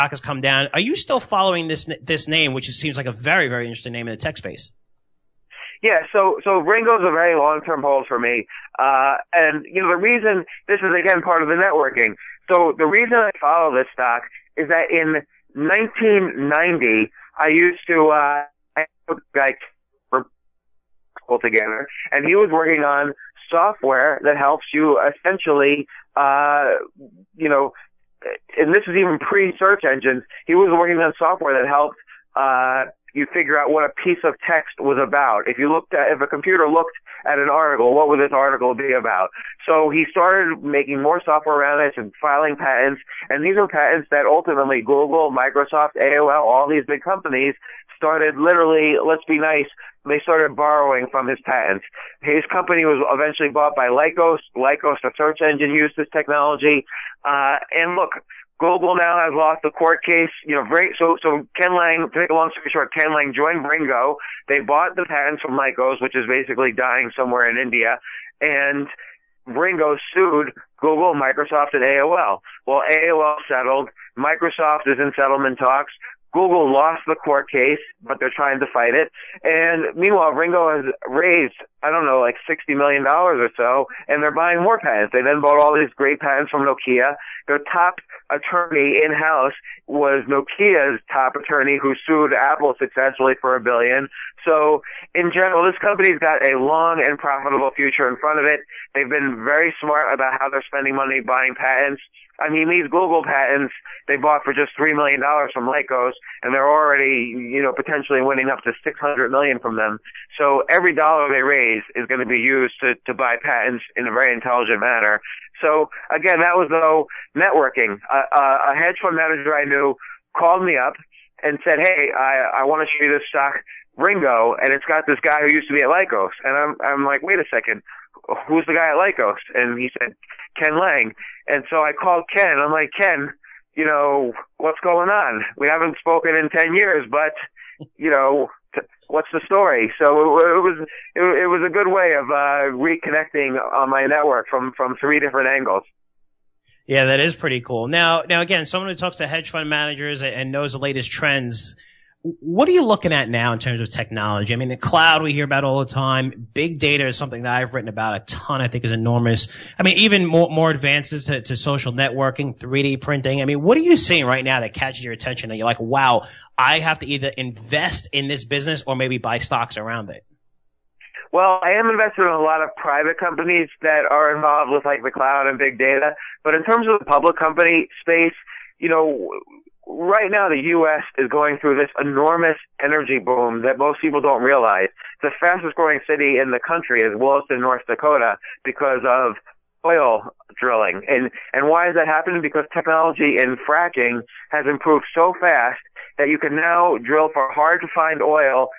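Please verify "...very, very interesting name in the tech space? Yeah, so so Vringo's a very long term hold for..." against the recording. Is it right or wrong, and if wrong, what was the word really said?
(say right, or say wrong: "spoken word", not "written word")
right.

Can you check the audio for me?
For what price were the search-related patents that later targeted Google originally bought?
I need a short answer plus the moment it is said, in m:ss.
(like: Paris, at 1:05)
$3 million, at 1:44.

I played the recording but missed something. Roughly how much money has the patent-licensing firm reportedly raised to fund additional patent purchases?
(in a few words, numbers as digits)
$60 million.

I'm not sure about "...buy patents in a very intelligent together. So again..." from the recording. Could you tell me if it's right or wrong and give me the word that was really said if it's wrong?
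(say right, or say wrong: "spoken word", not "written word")
wrong: "manner", not "together".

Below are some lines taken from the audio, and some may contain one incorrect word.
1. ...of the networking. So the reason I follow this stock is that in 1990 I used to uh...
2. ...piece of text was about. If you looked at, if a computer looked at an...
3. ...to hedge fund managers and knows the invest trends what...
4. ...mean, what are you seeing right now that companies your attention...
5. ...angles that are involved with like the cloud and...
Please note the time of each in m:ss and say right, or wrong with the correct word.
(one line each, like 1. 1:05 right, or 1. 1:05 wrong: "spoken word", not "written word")
1. 0:11 right
2. 0:34 right
3. 2:29 wrong: "latest", not "invest"
4. 2:43 wrong: "catches", not "companies"
5. 2:53 wrong: "companies", not "angles".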